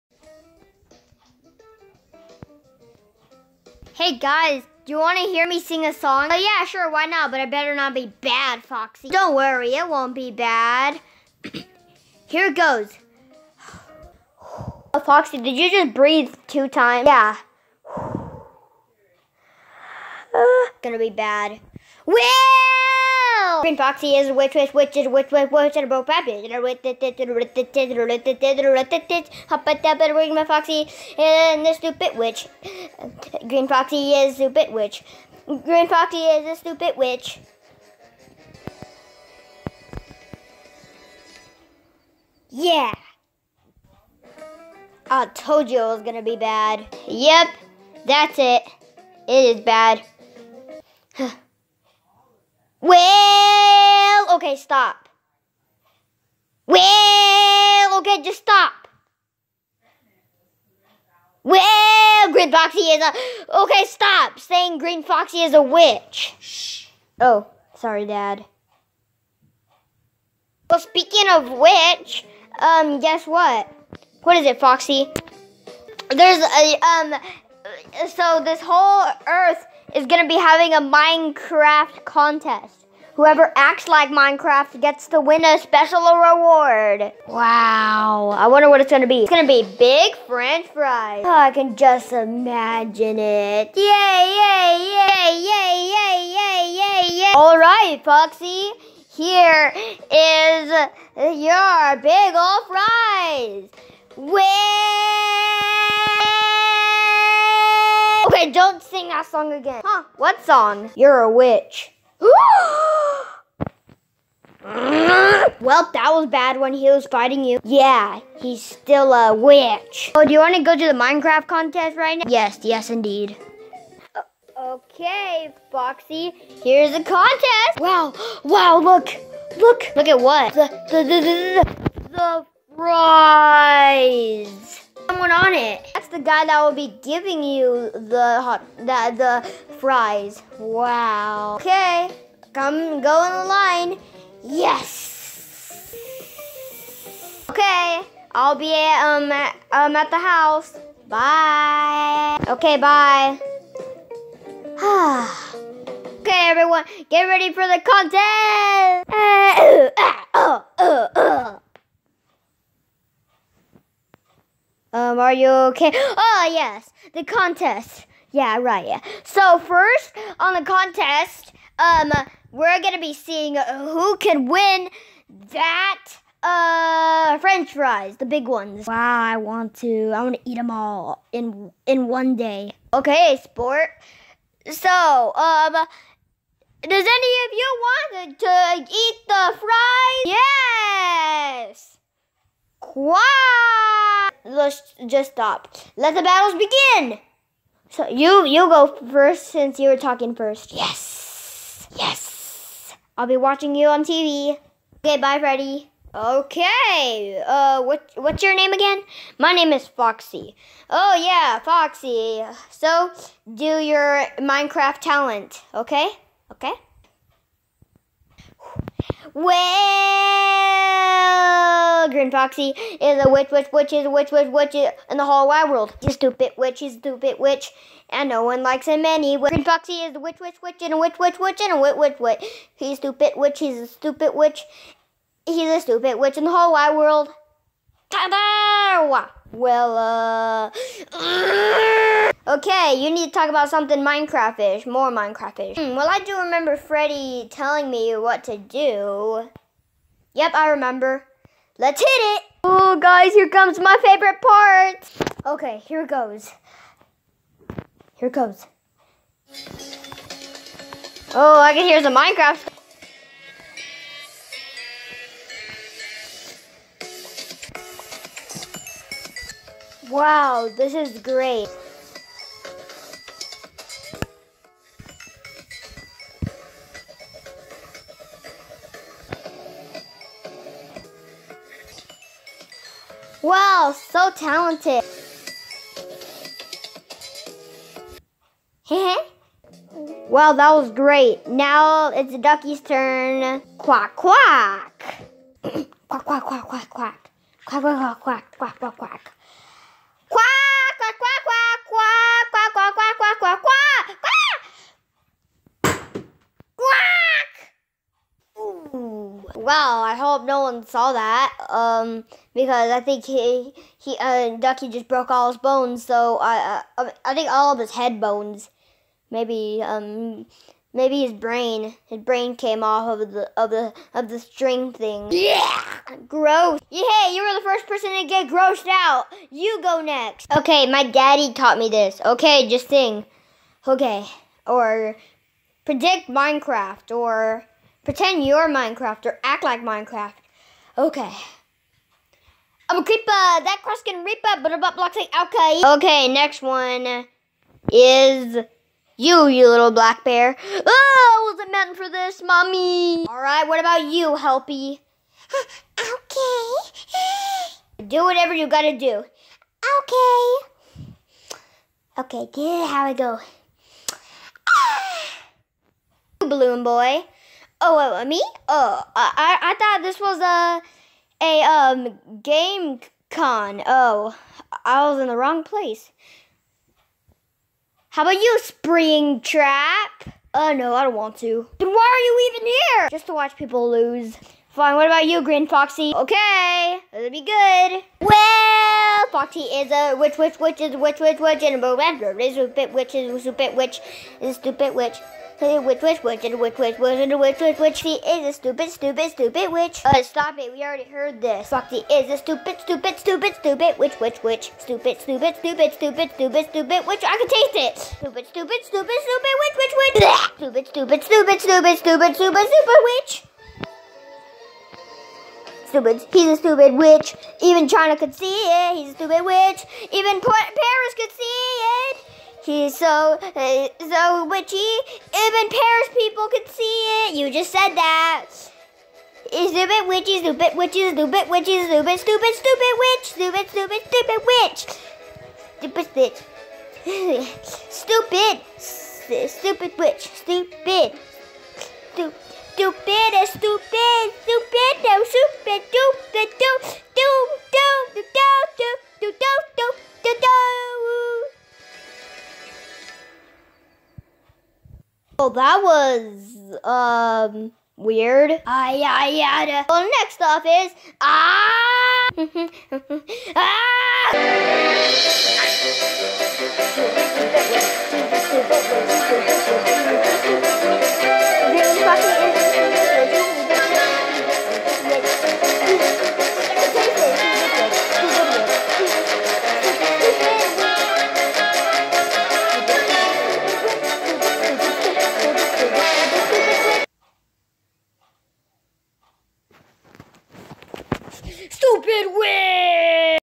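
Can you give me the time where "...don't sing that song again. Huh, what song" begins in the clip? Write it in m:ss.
1:48.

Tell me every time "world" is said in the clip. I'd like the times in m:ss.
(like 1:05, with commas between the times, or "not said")
3:45, 3:56.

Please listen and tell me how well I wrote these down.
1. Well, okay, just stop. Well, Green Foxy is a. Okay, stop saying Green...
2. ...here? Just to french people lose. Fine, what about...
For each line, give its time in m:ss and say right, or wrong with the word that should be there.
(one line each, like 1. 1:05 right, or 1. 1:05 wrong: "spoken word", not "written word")
1. 0:56 right
2. 6:22 wrong: "watch", not "french".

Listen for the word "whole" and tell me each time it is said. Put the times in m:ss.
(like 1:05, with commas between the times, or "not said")
1:18, 3:45, 3:56.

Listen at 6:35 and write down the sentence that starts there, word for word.
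Cause which witch, witch, and which witch, which and which witch, which.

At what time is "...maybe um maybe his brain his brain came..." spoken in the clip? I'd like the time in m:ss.
5:19.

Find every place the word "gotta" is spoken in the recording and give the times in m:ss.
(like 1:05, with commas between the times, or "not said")
5:58.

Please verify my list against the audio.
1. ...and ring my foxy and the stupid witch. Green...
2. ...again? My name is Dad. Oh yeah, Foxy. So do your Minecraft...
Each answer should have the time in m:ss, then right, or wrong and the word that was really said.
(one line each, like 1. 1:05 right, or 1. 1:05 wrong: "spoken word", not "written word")
1. 0:30 right
2. 3:28 wrong: "Foxy", not "Dad".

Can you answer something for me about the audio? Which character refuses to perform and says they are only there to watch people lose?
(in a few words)
Springtrap.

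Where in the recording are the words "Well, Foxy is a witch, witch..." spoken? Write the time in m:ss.
6:28.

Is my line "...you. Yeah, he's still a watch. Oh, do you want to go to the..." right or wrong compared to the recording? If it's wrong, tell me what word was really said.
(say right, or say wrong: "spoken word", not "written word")
wrong: "witch", not "watch".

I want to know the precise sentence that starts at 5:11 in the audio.
Um, because I think he he uh, Ducky just broke all his bones.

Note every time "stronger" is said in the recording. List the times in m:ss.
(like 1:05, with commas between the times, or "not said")
not said.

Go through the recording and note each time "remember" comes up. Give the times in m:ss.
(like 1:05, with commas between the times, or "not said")
4:06, 4:10.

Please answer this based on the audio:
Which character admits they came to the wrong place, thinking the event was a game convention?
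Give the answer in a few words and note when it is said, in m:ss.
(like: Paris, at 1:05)
Balloon boy, at 6:06.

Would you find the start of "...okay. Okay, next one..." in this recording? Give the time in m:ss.
5:45.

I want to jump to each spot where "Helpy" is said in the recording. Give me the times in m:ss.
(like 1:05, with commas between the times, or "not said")
5:54.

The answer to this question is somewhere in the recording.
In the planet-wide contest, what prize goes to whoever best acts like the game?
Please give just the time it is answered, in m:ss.
1:29.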